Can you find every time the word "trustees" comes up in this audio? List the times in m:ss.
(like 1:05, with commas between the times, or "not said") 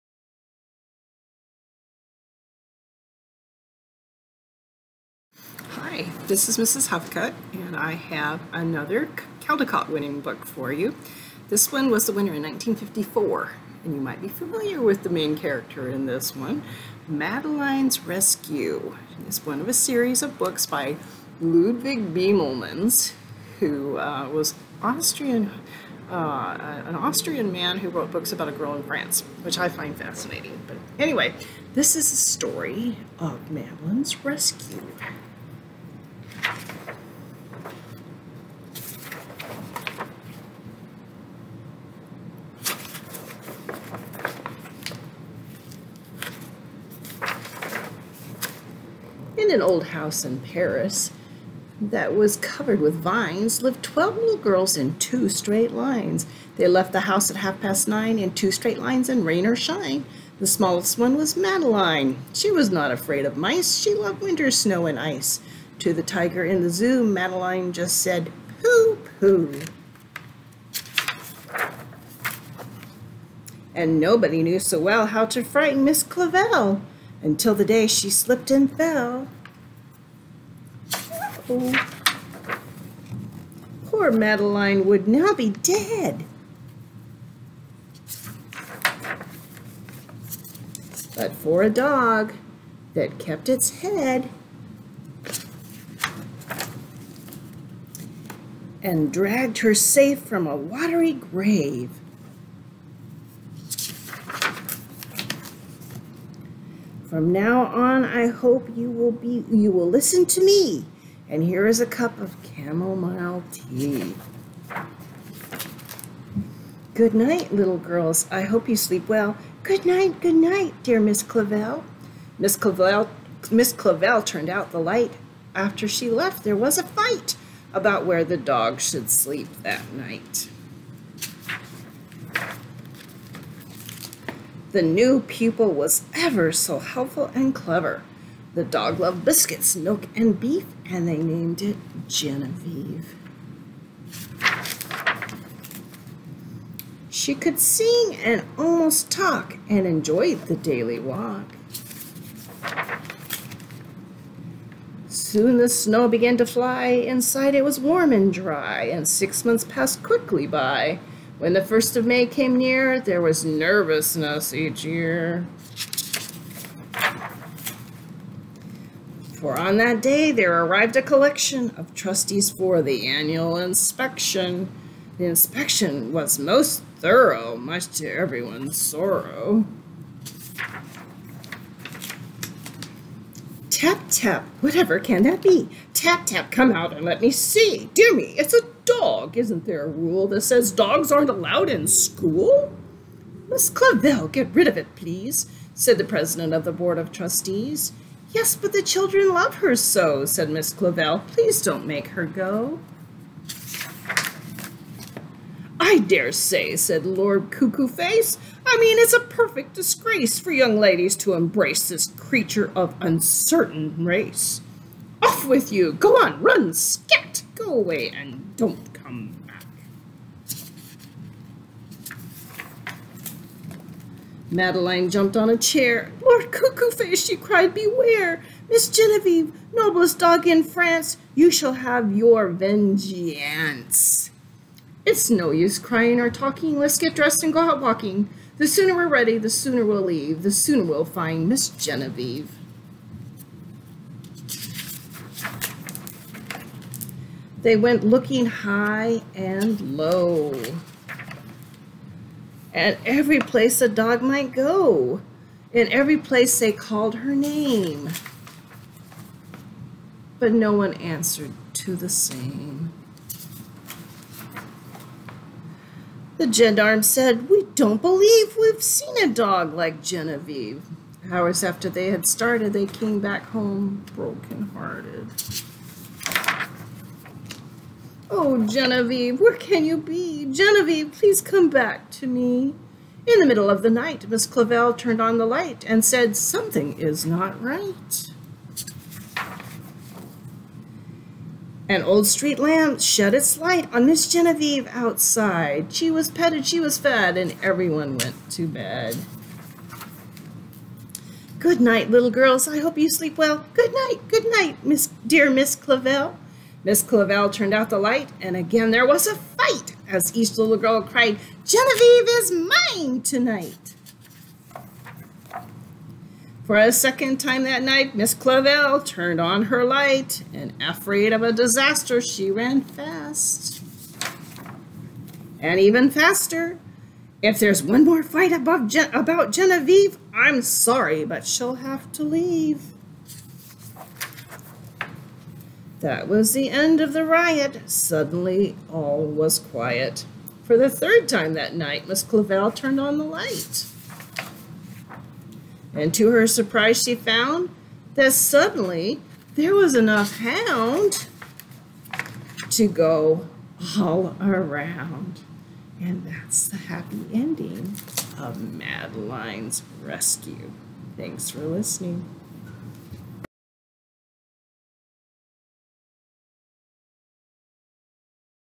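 2:51, 3:17.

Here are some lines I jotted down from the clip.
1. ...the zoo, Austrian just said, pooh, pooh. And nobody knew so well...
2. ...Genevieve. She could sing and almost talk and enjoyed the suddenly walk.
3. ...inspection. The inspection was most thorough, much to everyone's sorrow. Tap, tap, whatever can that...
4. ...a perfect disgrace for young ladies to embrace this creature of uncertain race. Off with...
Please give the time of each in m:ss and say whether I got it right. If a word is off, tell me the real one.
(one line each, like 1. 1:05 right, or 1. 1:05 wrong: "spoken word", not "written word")
1. 1:06 wrong: "Madeline", not "Austrian"
2. 2:22 wrong: "daily", not "suddenly"
3. 2:53 right
4. 3:29 right.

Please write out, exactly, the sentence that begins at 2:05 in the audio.
After she left, there was a fight about where the dog should sleep that night.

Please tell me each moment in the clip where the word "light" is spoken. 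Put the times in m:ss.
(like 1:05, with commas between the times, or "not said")
2:04, 4:45, 4:53, 5:07, 5:19, 5:43.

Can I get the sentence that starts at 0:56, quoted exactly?
They left the house at half past nine in two straight lines in rain or shine.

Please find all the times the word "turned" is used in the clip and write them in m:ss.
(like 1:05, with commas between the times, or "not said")
2:04, 4:44, 5:07, 5:19, 5:42.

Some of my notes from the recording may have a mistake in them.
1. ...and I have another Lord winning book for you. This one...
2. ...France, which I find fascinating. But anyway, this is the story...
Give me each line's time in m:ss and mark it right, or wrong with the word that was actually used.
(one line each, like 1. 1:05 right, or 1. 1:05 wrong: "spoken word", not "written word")
1. 0:07 wrong: "Caldecott", not "Lord"
2. 0:28 right.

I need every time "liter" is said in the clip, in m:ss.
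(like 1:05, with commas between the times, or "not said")
not said.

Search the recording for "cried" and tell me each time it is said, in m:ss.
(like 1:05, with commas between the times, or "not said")
3:47, 5:11.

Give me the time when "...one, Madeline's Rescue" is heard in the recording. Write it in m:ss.
0:16.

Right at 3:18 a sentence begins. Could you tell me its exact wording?
Yes, but the children love her so, said Miss Clavel.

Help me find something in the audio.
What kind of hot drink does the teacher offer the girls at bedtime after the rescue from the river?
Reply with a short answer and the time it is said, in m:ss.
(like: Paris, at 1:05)
Chamomile tea, at 1:52.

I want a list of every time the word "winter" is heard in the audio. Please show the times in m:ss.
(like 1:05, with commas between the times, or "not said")
1:04.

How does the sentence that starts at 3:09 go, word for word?
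Isn't there a rule that says dogs aren't allowed in school?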